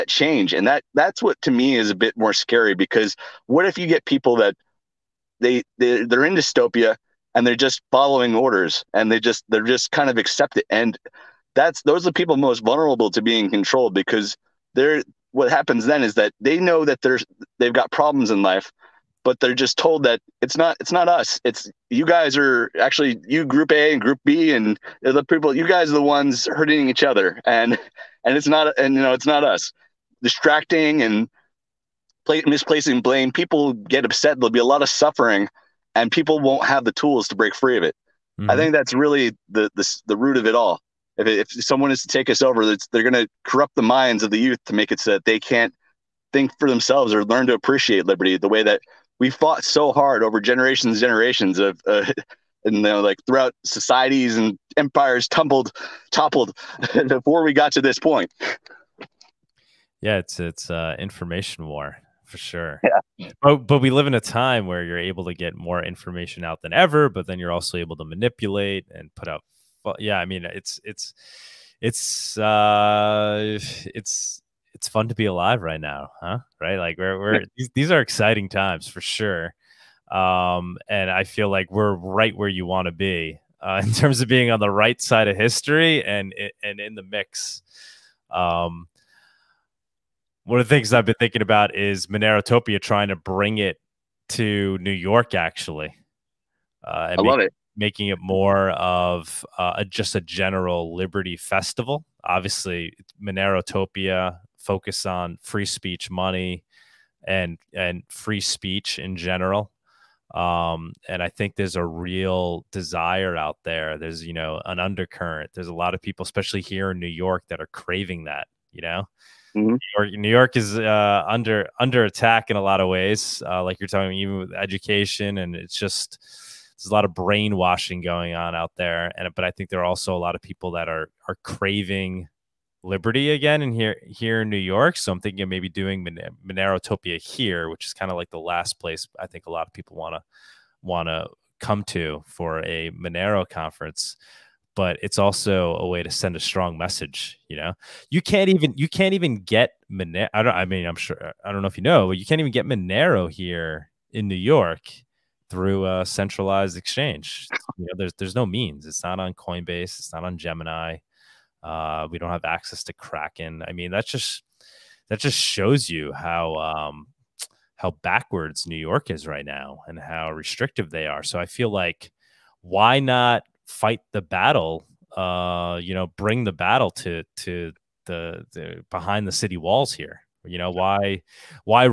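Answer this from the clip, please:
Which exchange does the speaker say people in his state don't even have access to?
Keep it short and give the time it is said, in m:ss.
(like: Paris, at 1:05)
Kraken, at 2:42.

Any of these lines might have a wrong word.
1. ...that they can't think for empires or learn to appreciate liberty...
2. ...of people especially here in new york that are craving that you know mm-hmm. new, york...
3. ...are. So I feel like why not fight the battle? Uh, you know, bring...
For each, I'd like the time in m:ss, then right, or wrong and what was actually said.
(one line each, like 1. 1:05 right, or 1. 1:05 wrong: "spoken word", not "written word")
1. 0:45 wrong: "themselves", not "empires"
2. 1:55 right
3. 2:51 right.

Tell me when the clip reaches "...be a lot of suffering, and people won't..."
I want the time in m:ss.
0:34.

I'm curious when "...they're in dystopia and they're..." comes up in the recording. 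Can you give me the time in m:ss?
0:06.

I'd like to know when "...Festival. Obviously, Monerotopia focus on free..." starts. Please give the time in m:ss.
1:41.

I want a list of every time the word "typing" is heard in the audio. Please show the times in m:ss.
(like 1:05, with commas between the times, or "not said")
not said.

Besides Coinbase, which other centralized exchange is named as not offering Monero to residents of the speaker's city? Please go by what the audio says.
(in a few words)
Gemini.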